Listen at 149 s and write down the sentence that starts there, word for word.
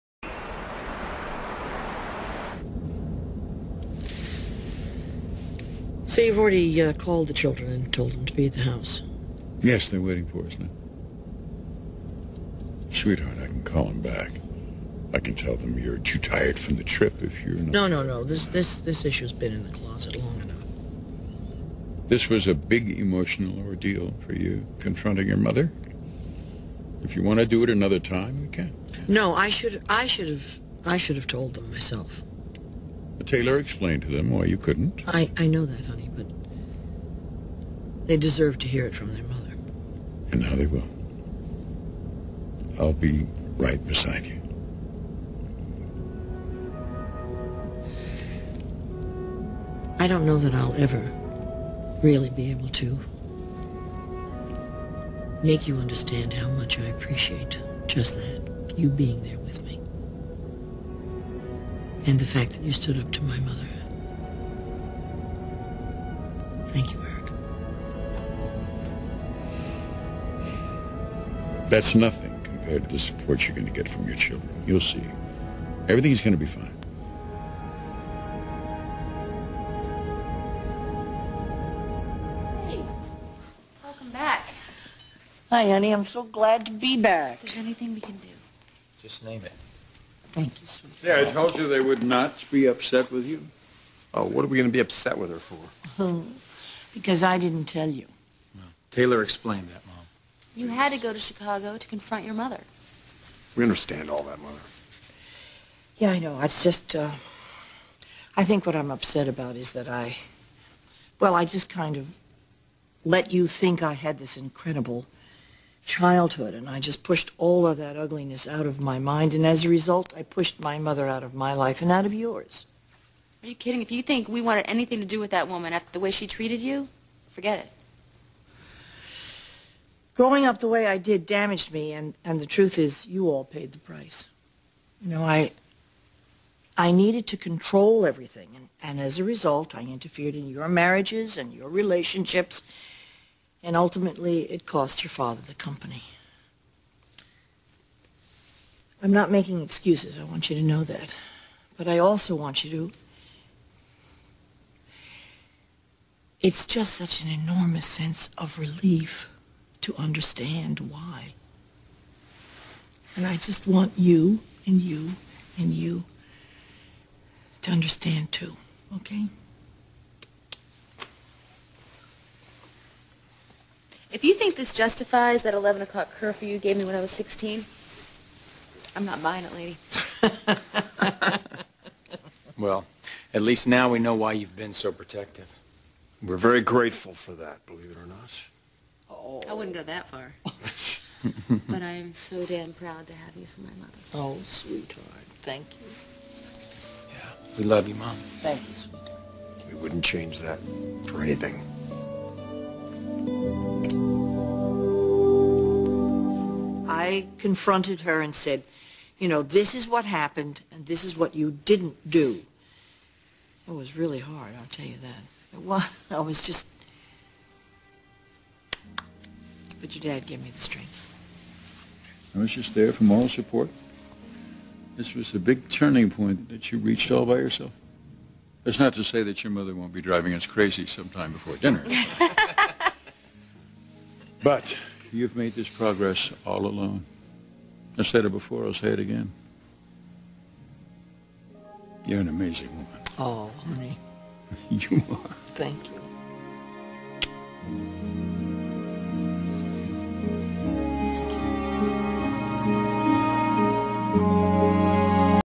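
I'm not making excuses, I want you to know that.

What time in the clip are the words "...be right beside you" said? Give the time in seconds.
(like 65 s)
42 s.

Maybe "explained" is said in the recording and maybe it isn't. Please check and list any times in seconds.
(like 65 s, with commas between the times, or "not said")
33 s, 99 s.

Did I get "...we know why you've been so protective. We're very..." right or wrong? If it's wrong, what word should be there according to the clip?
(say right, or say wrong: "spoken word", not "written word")
right.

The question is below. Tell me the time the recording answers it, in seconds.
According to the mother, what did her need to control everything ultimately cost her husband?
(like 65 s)
145 s.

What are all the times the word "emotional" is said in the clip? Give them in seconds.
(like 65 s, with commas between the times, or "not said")
22 s.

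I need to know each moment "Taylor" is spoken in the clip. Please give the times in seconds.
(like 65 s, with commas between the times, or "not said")
33 s, 98 s.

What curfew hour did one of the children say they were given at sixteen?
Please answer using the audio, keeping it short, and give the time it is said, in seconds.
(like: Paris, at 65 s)
11 o'clock, at 175 s.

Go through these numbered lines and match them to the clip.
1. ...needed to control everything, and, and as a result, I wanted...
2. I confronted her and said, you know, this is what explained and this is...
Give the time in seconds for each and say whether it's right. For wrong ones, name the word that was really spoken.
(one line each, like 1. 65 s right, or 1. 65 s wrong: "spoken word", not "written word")
1. 136 s wrong: "interfered", not "wanted"
2. 207 s wrong: "happened", not "explained".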